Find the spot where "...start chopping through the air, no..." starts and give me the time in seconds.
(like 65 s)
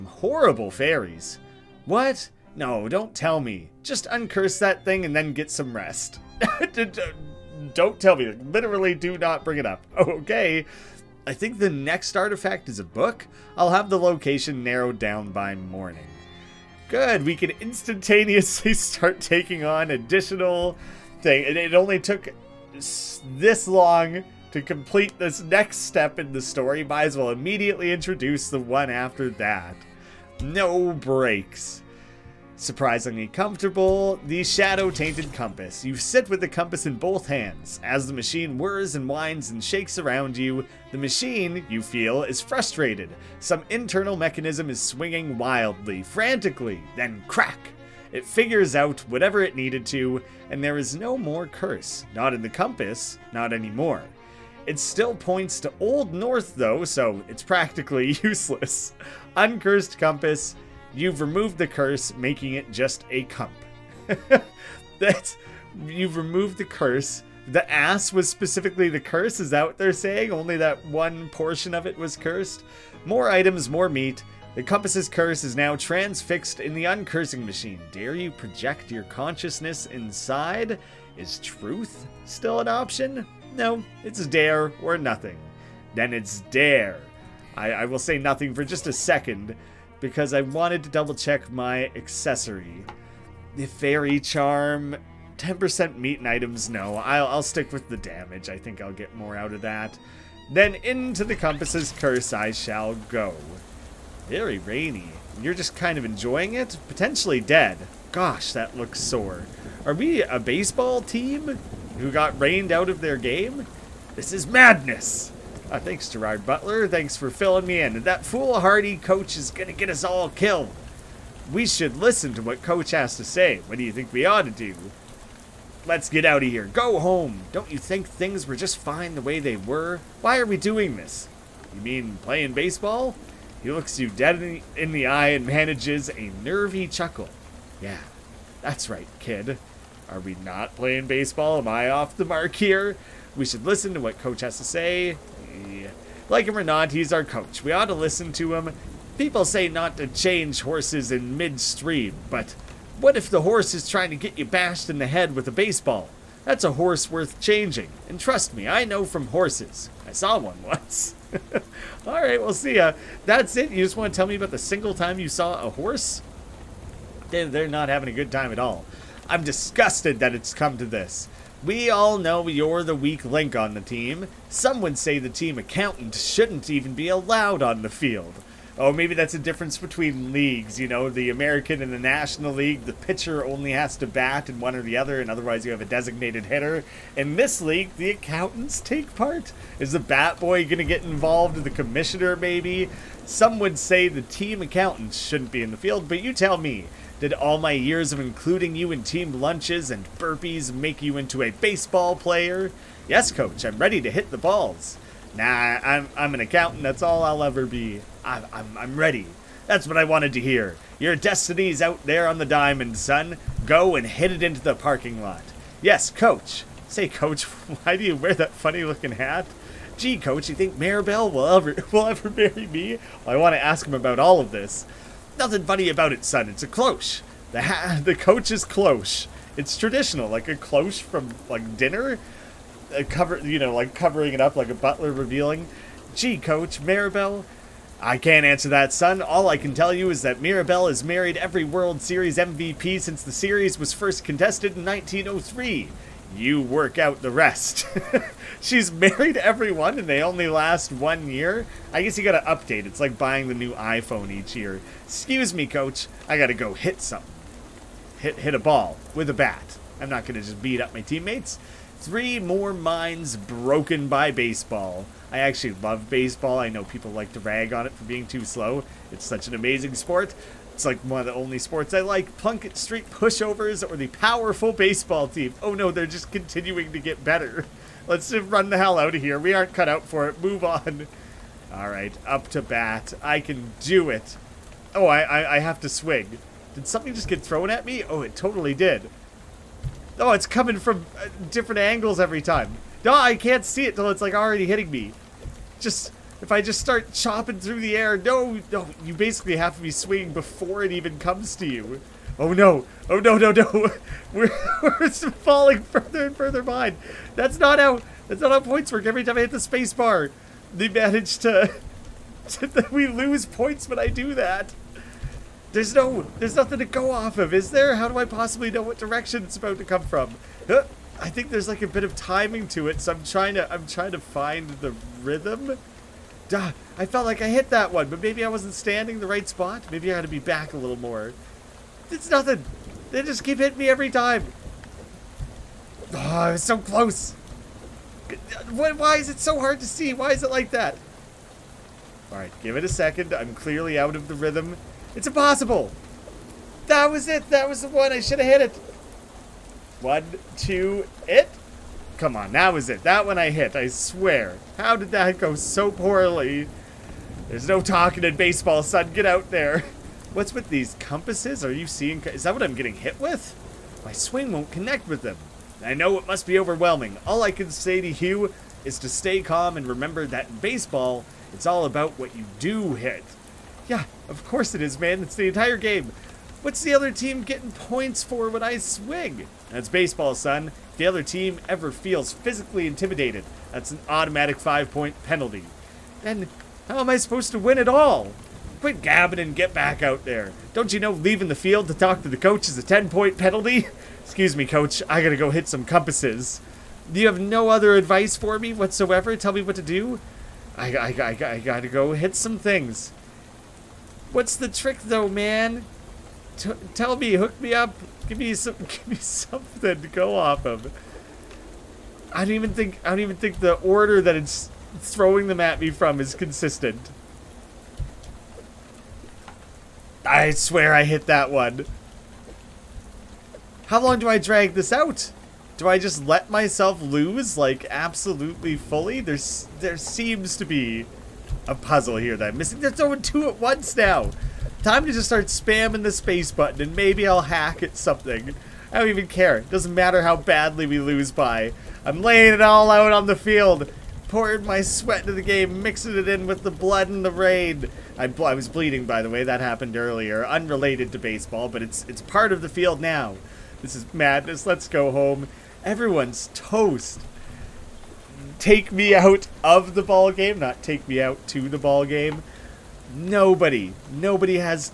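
296 s.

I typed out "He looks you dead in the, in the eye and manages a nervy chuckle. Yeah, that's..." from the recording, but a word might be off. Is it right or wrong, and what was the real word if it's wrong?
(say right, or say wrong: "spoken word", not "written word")
right.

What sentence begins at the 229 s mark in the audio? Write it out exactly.
It's traditional, like a cloche from like dinner, uh, cover you know like covering it up like a butler revealing.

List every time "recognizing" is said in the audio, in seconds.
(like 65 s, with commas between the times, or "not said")
not said.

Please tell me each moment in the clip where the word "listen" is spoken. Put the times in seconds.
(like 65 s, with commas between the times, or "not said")
121 s, 143 s, 147 s.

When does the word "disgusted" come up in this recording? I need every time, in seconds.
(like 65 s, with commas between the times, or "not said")
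169 s.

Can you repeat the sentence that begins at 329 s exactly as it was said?
Maybe I had to be back a little more.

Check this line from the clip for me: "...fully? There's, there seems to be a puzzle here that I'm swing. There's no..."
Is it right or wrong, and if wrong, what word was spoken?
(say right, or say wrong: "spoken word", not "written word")
wrong: "missing", not "swing".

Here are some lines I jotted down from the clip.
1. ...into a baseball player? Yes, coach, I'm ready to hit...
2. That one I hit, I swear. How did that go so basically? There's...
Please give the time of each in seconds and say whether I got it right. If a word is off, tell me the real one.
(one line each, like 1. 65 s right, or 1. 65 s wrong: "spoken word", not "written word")
1. 201 s right
2. 353 s wrong: "poorly", not "basically".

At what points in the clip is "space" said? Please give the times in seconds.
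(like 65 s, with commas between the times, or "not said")
309 s, 436 s.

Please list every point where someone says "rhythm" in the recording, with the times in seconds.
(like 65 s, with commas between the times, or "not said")
325 s, 344 s.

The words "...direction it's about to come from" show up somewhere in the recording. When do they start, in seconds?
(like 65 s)
318 s.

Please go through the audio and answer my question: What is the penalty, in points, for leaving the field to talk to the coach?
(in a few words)
10 points.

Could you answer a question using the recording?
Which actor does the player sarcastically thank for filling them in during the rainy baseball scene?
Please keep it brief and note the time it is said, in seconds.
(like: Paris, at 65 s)
Gerard Butler, at 116 s.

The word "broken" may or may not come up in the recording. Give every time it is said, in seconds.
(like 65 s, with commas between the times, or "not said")
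263 s.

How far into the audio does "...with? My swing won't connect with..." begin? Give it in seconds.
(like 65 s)
363 s.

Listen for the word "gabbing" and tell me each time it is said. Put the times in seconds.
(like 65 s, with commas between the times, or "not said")
389 s.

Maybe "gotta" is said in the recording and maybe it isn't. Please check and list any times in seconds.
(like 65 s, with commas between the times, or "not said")
252 s, 256 s, 395 s, 401 s.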